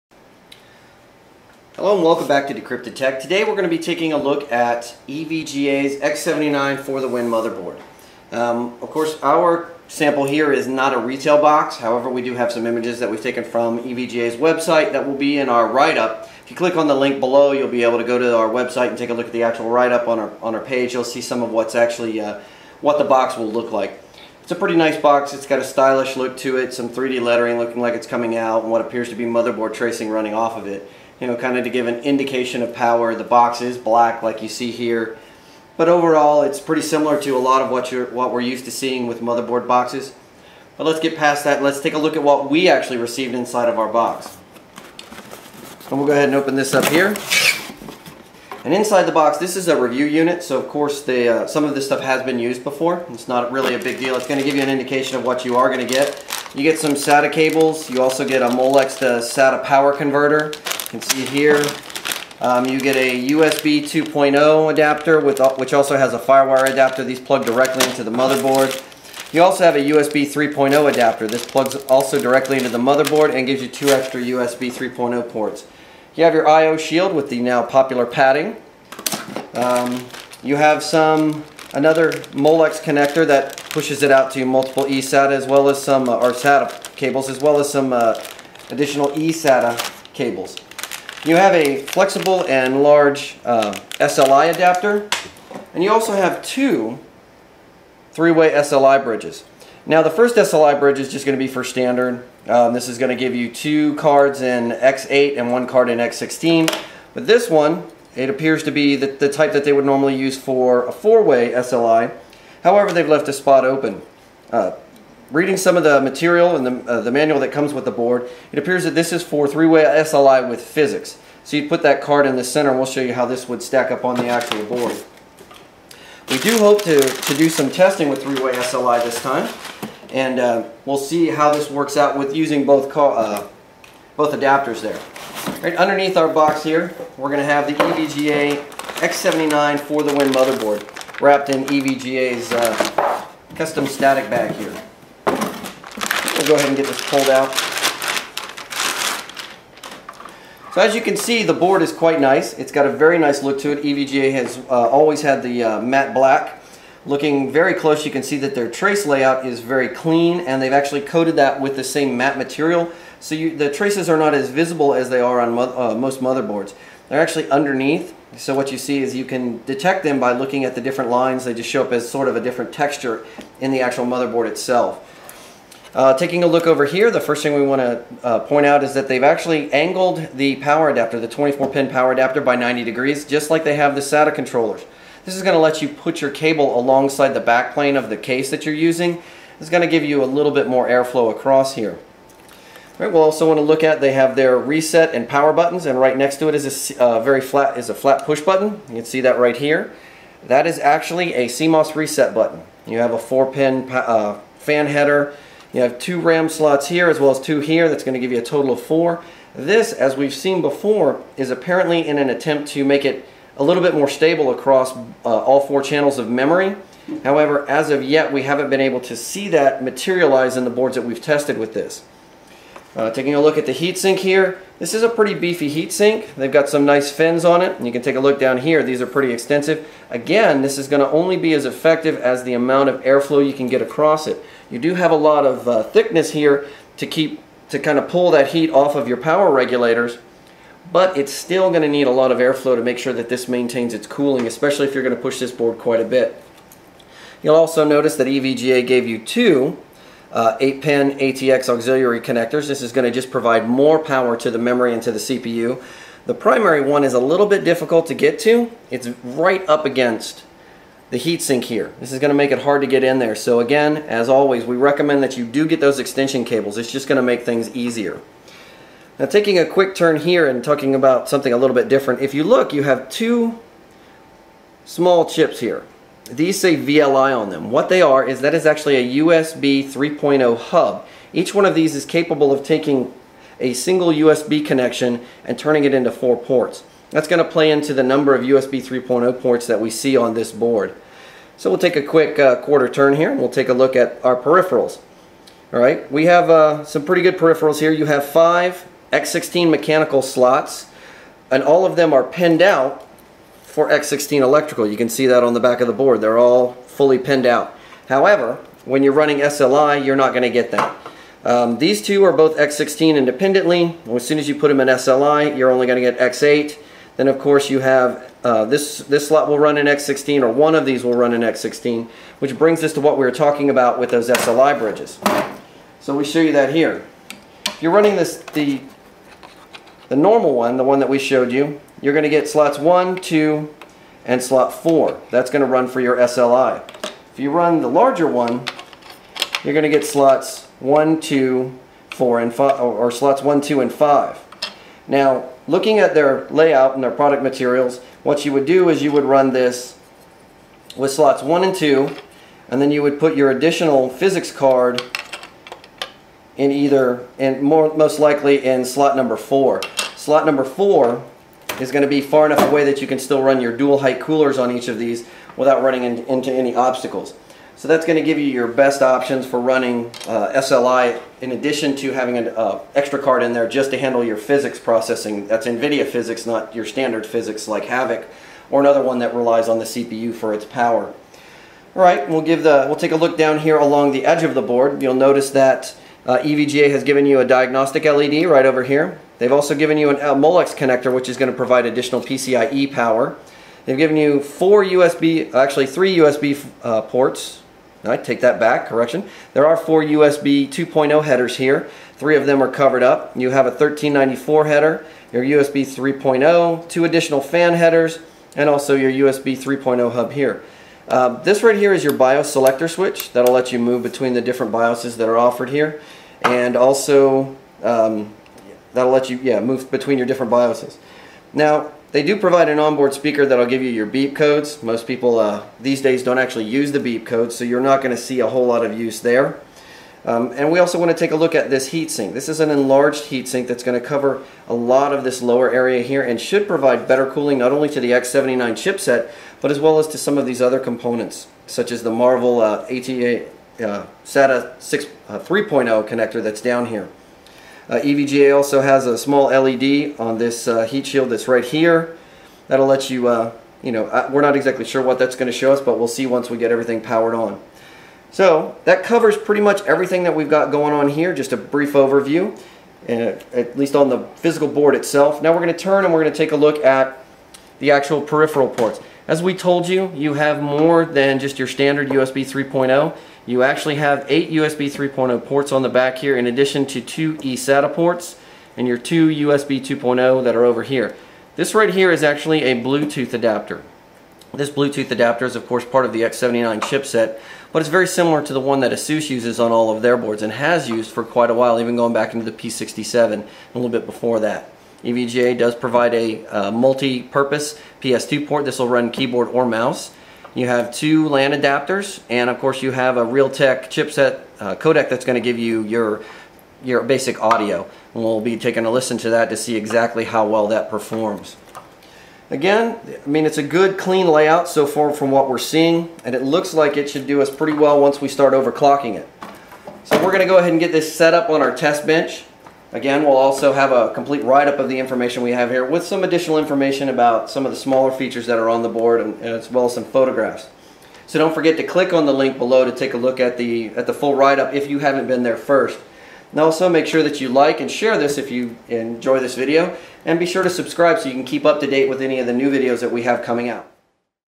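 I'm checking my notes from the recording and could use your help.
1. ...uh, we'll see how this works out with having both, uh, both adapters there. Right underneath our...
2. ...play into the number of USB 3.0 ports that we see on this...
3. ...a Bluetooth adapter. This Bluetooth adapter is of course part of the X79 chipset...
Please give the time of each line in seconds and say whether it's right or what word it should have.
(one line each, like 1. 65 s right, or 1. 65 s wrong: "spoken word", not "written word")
1. 130 s wrong: "using", not "having"
2. 287 s right
3. 482 s right.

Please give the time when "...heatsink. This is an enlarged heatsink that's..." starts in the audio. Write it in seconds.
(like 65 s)
431 s.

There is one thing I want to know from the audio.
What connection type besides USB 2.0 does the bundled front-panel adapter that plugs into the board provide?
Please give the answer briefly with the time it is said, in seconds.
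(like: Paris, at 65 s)
FireWire, at 66 s.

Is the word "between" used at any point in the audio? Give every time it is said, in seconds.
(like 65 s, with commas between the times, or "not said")
414 s, 419 s.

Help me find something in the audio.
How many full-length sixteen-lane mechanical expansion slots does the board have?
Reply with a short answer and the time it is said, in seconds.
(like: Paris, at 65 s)
5, at 298 s.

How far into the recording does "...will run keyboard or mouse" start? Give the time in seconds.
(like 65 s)
498 s.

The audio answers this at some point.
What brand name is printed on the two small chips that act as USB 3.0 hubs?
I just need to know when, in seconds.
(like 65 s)
276 s.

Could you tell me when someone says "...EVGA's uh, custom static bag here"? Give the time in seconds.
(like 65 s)
141 s.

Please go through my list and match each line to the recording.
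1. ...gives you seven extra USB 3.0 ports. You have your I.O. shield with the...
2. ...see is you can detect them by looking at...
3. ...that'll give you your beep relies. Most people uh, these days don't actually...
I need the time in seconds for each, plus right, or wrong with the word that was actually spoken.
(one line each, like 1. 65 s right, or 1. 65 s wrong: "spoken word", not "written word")
1. 73 s wrong: "two", not "seven"
2. 168 s right
3. 423 s wrong: "codes", not "relies".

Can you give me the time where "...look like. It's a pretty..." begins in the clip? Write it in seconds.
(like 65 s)
23 s.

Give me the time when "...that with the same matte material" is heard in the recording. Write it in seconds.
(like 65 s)
161 s.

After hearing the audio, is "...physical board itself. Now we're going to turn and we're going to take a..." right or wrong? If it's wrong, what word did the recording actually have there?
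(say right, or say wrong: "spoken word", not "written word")
right.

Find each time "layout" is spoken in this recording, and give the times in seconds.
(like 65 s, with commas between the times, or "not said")
159 s, 346 s, 514 s.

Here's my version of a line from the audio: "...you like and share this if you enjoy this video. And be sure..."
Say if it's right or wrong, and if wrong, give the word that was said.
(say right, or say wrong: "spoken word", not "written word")
right.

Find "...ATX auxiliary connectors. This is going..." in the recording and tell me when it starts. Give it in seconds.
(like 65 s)
251 s.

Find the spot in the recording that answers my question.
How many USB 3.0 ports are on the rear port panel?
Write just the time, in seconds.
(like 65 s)
474 s.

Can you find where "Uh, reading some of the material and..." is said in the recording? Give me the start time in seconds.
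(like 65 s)
114 s.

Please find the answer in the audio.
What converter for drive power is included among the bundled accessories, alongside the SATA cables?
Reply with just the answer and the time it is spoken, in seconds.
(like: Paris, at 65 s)
Molex to SATA power converter, at 58 s.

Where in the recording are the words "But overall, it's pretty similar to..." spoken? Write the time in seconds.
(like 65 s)
35 s.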